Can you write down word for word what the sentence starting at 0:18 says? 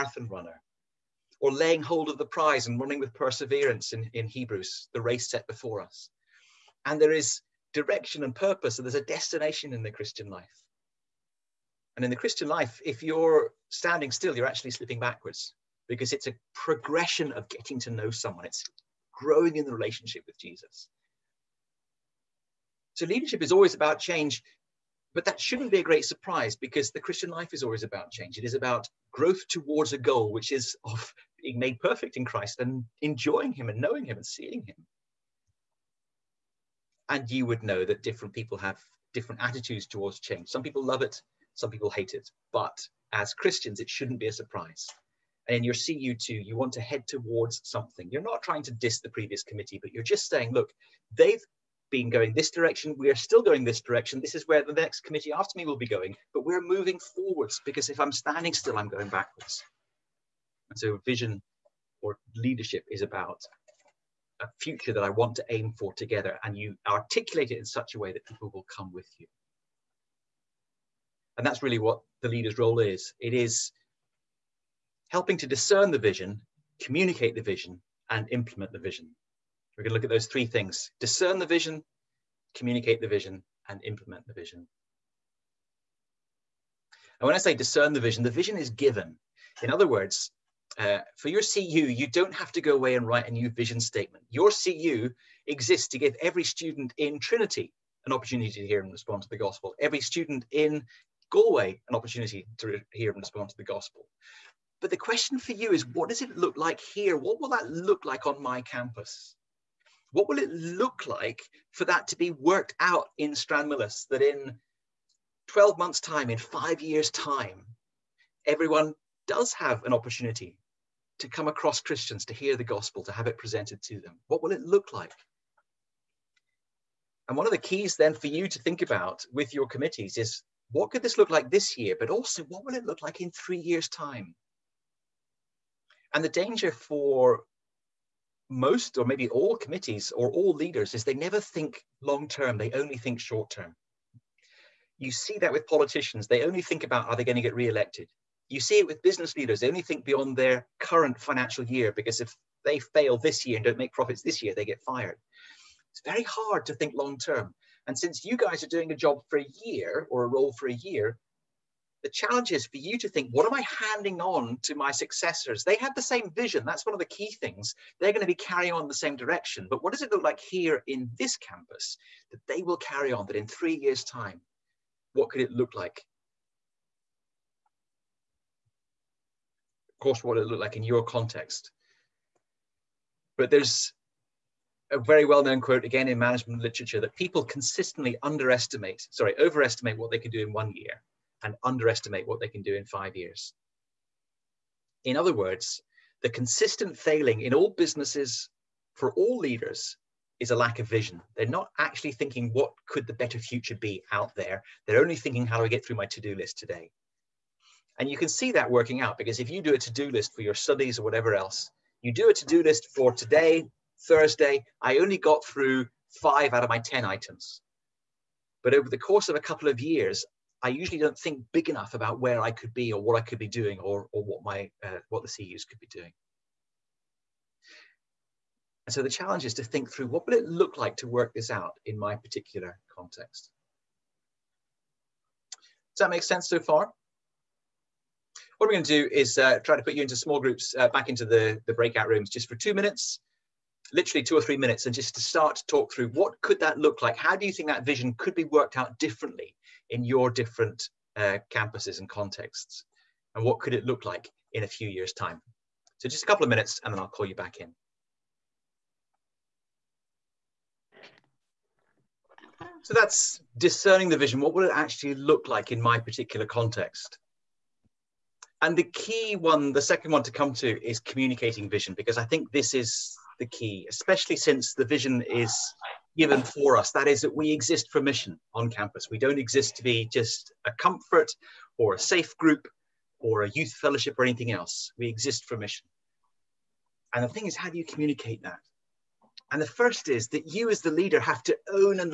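It's growing in the relationship with Jesus.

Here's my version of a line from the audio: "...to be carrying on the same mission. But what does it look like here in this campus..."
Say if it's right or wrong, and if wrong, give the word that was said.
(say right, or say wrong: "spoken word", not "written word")
wrong: "direction", not "mission".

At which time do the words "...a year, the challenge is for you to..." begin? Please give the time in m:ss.
2:40.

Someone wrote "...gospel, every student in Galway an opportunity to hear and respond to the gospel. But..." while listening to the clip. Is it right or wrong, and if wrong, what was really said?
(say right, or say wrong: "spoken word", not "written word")
right.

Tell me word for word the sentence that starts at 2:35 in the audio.
It's very hard to think long term.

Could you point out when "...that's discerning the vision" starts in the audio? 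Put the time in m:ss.
4:22.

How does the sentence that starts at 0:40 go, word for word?
Some people love it, some people hate it, but as Christians, it shouldn't be a surprise.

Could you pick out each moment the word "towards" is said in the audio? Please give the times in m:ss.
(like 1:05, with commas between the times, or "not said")
0:29, 0:39, 0:47.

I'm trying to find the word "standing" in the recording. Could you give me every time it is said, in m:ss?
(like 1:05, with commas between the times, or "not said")
0:13, 0:58.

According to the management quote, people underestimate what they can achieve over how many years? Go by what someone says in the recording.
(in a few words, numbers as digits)
5.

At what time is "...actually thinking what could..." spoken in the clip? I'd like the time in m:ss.
3:21.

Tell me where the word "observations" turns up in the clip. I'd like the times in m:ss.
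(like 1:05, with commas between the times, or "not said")
not said.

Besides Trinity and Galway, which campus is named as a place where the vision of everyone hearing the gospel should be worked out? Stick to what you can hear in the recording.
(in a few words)
Stranmillis.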